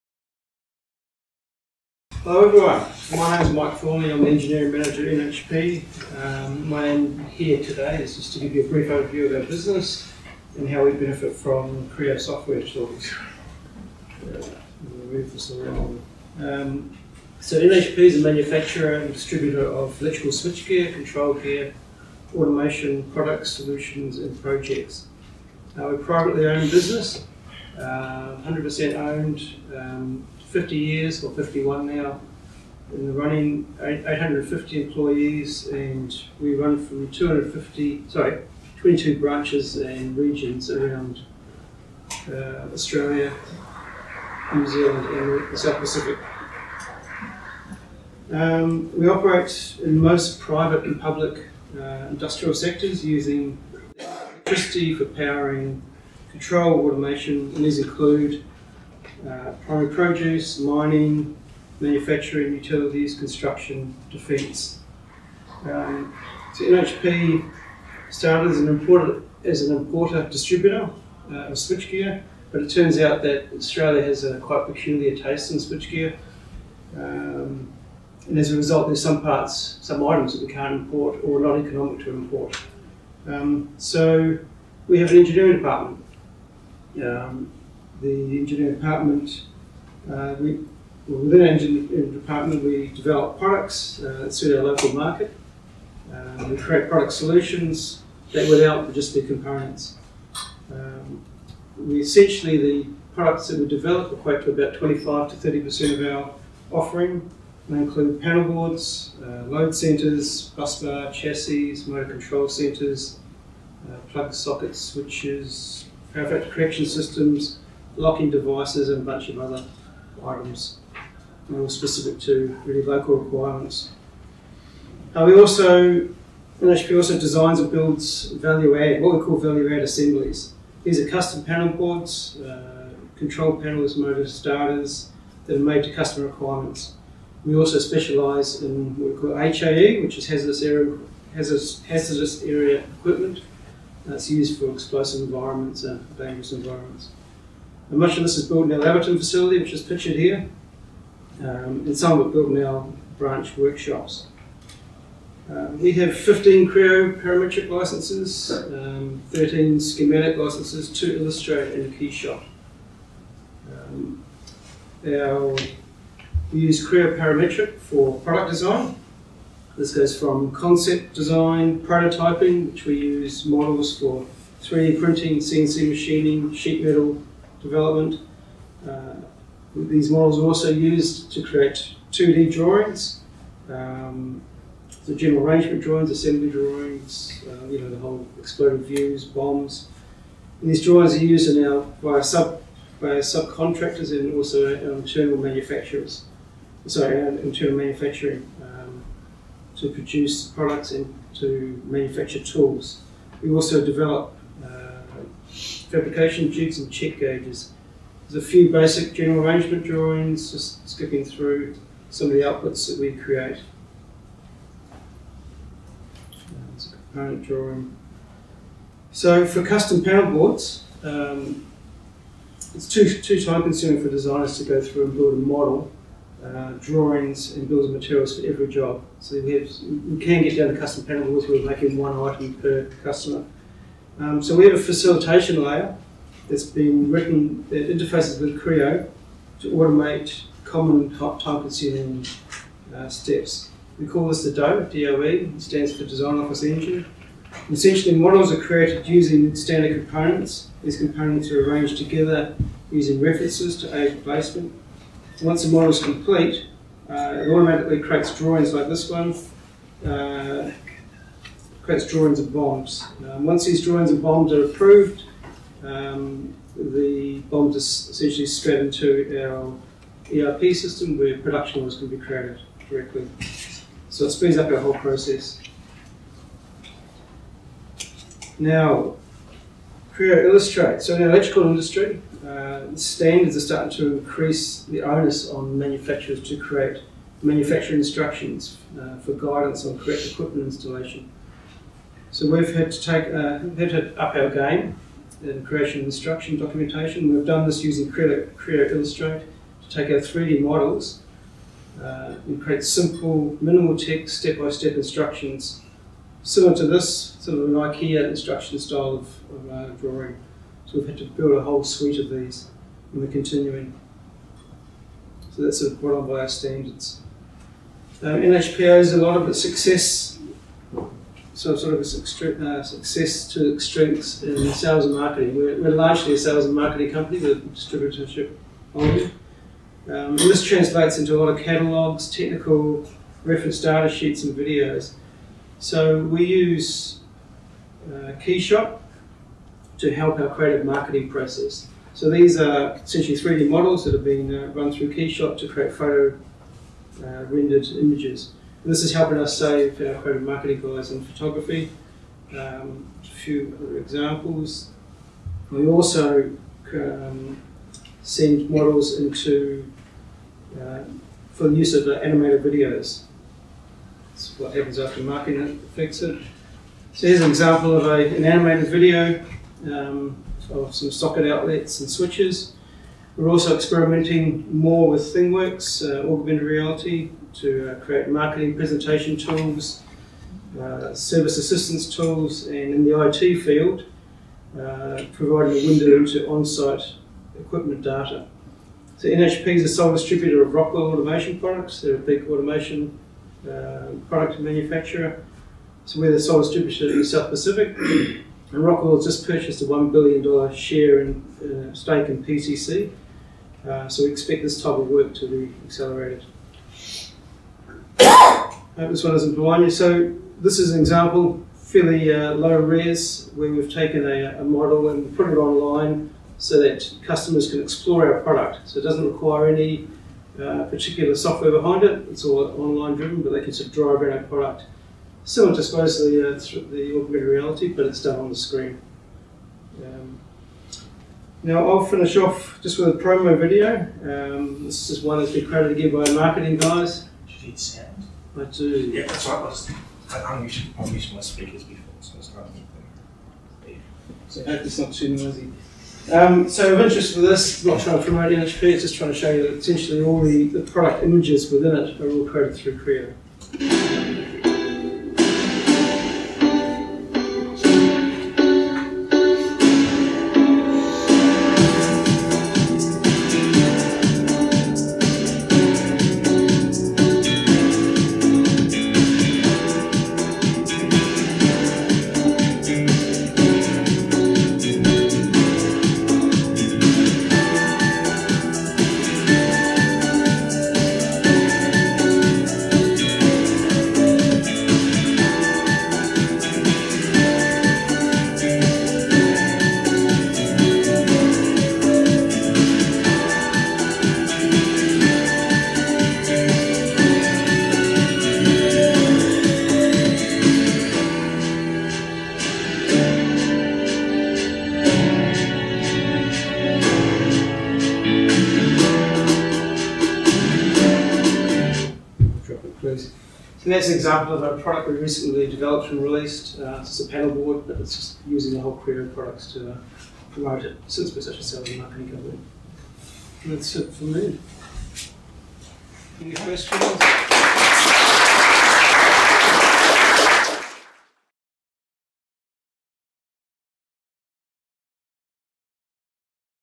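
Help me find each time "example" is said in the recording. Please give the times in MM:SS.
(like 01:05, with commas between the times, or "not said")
05:53, 06:07, 06:51, 08:34.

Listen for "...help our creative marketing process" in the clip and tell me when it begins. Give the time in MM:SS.
05:40.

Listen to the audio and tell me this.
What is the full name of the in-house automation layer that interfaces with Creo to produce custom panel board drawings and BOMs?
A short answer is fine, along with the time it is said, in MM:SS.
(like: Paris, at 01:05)
Design Office Engine, at 04:06.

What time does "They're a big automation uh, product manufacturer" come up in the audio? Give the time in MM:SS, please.
06:32.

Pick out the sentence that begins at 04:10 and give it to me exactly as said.
These components are arranged together using references to aid placement.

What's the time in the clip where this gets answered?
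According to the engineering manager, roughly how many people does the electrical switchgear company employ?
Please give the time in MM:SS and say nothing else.
00:33.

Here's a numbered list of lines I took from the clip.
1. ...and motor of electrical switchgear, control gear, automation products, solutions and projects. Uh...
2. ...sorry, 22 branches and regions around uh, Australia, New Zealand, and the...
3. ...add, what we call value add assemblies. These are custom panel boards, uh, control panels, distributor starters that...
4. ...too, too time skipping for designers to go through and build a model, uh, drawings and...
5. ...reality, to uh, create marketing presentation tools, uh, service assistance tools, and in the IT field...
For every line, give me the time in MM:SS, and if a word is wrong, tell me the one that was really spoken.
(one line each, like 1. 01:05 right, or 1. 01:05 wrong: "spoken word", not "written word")
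1. 00:18 wrong: "distributor", not "motor"
2. 00:38 right
3. 02:08 wrong: "motor", not "distributor"
4. 03:42 wrong: "consuming", not "skipping"
5. 06:16 right.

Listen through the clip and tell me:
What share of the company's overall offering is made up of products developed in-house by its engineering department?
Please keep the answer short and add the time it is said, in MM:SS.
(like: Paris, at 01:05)
25 to 30%, at 01:44.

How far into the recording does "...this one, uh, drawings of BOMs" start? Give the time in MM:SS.
04:18.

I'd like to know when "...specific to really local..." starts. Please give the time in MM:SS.
02:01.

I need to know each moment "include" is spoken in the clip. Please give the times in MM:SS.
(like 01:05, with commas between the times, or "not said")
00:57, 01:47.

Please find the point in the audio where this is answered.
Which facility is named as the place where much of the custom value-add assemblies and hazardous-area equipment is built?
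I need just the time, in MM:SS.
02:28.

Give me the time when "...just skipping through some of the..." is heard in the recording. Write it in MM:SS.
03:30.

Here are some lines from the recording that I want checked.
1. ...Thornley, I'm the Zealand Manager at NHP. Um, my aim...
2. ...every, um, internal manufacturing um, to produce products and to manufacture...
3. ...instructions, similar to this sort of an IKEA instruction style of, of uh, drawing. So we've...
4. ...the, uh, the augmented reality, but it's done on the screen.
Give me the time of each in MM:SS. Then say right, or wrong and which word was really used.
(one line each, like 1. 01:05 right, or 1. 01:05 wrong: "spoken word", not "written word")
1. 00:03 wrong: "Engineering", not "Zealand"
2. 03:16 wrong: "sorry", not "every"
3. 05:05 right
4. 07:05 right.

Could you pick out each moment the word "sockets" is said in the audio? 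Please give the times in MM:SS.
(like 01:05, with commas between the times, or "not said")
01:54, 06:11.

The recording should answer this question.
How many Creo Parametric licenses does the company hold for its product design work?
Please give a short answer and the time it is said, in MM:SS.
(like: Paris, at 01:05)
15, at 02:36.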